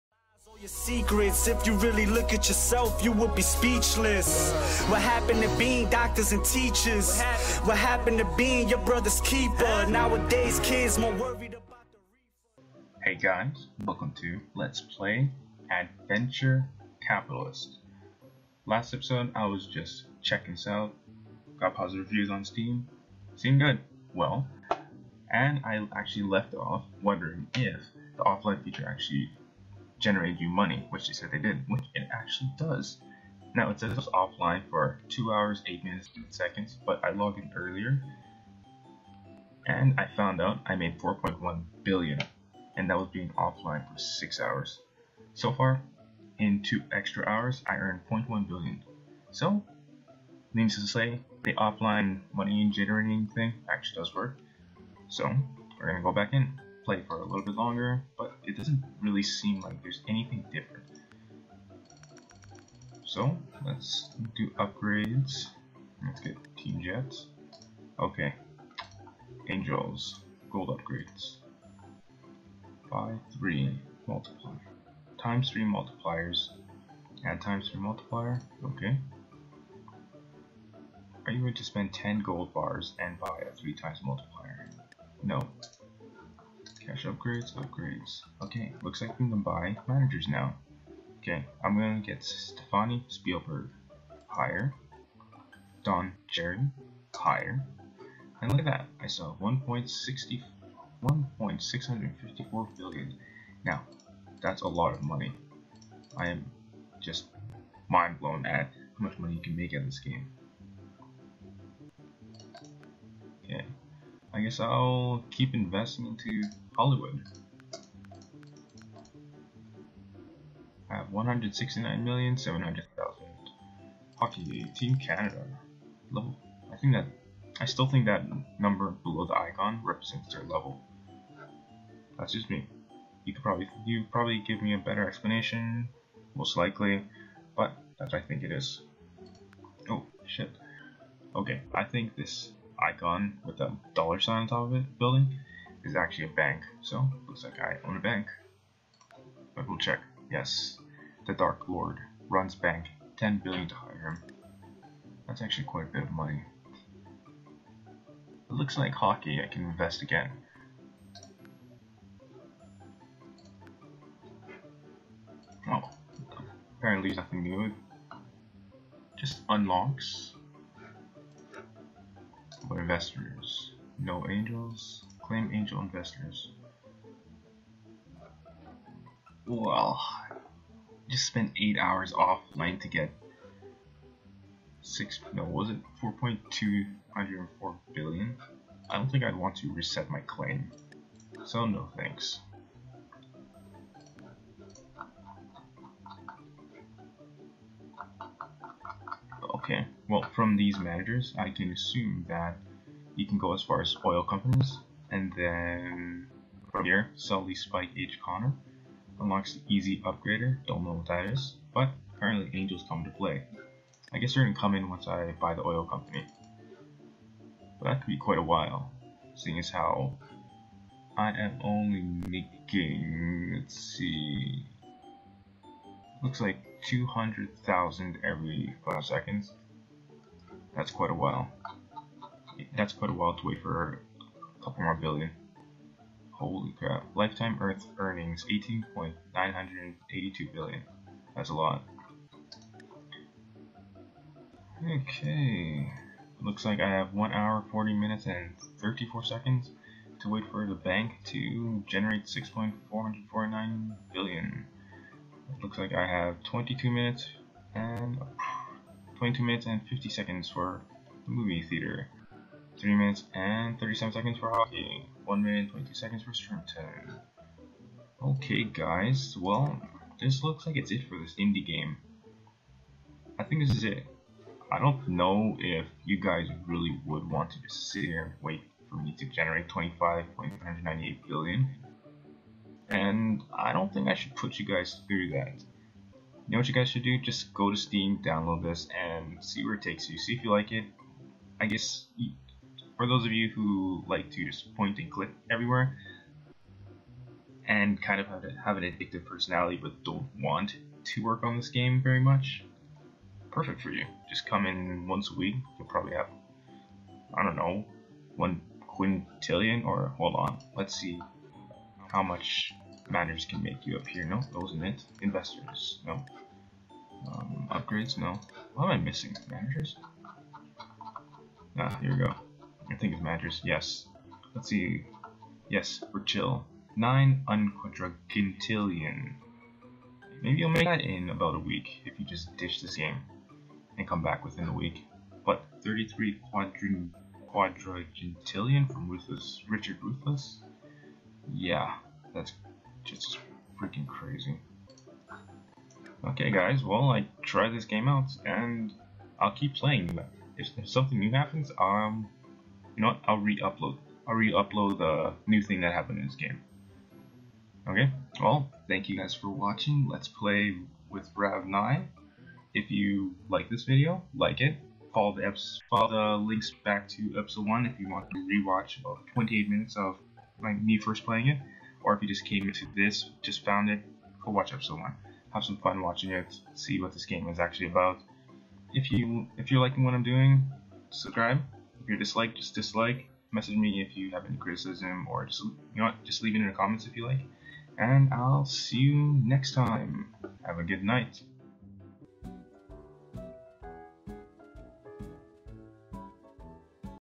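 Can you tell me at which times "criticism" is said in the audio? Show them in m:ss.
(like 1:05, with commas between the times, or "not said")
6:24.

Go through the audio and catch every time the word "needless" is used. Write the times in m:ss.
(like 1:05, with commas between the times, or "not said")
0:50.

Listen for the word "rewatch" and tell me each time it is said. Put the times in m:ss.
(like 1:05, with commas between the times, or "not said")
6:08.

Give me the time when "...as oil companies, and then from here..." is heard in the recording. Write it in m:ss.
3:23.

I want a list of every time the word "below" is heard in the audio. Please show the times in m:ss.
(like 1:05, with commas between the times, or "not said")
2:09.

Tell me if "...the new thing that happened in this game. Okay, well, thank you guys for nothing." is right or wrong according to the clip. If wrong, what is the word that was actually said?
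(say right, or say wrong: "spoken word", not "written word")
wrong: "watching", not "nothing".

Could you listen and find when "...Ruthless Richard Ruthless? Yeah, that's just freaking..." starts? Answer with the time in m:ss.
5:39.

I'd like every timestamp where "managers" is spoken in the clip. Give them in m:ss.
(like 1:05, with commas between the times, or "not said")
1:29, 3:20, 5:13, 5:19.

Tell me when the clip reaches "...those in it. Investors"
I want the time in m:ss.
5:14.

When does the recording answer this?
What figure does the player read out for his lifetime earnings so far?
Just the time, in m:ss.
3:58.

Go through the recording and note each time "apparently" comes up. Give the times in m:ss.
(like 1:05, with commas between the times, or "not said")
2:46, 3:32.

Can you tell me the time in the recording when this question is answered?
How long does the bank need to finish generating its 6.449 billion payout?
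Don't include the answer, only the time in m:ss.
4:07.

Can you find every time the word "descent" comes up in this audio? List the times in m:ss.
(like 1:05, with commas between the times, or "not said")
not said.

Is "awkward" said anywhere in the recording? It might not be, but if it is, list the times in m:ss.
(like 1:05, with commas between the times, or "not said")
not said.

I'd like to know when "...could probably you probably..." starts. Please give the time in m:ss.
2:13.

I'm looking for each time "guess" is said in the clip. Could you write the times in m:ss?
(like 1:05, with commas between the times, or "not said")
1:54, 3:34, 4:51.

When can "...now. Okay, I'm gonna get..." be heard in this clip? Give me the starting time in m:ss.
1:30.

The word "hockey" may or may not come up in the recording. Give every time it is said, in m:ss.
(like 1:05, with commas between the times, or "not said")
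2:04, 2:38, 4:24.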